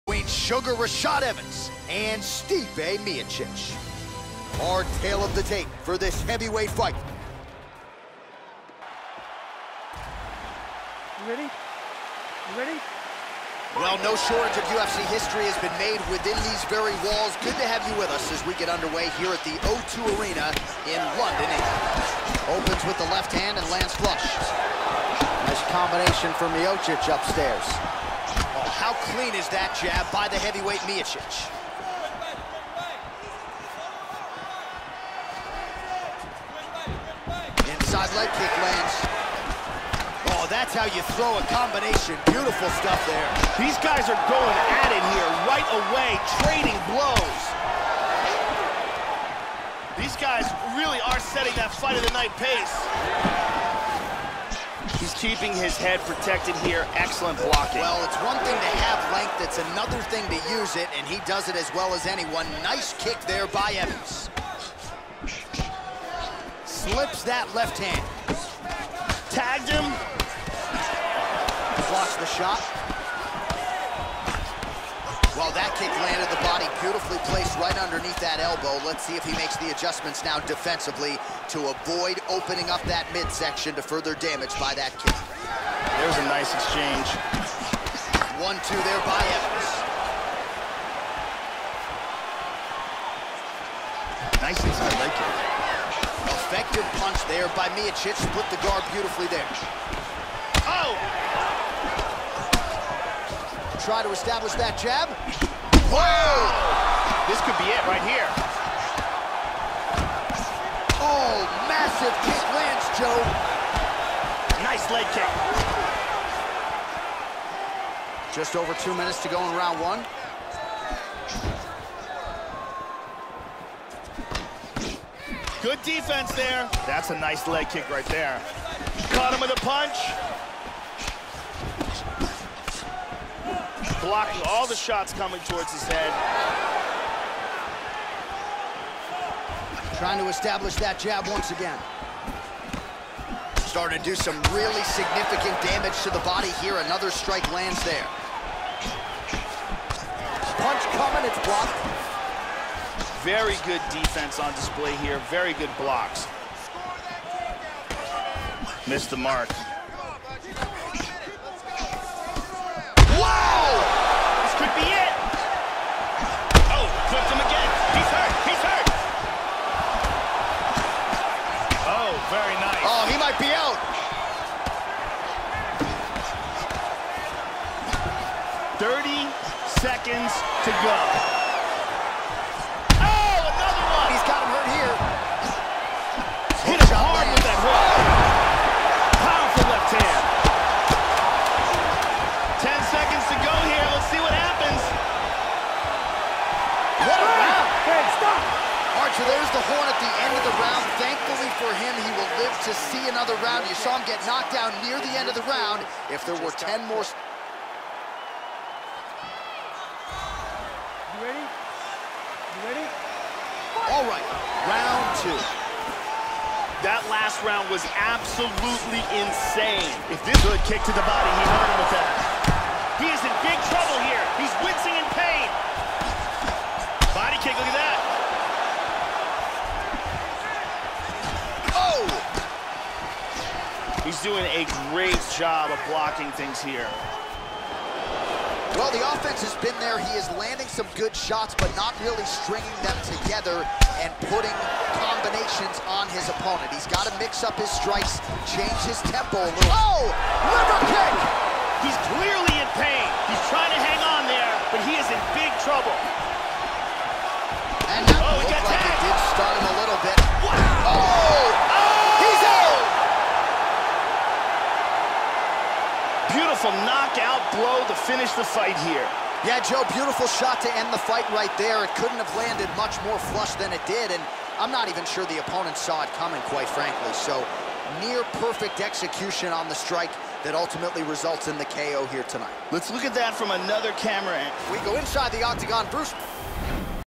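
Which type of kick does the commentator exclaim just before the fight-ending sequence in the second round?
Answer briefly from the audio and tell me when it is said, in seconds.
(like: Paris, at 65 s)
Liver kick, at 250 s.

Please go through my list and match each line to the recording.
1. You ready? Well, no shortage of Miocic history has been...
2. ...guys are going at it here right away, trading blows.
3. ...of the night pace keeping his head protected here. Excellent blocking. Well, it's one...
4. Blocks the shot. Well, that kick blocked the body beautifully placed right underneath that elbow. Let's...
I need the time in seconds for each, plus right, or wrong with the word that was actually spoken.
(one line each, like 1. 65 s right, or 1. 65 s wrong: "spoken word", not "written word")
1. 11 s wrong: "UFC", not "Miocic"
2. 43 s right
3. 51 s right
4. 71 s wrong: "landed", not "blocked".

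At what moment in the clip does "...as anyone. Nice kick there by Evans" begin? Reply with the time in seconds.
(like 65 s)
61 s.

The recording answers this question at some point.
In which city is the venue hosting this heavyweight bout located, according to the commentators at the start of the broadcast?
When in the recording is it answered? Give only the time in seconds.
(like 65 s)
21 s.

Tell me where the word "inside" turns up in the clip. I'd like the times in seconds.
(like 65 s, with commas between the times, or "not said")
37 s, 94 s, 284 s.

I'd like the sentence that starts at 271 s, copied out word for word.
It couldn't have landed much more flush than it did, and I'm not even sure the opponent saw it coming, quite frankly.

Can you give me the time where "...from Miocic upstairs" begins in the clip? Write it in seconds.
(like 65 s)
26 s.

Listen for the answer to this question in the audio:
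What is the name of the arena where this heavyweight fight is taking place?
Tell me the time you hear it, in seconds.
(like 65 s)
19 s.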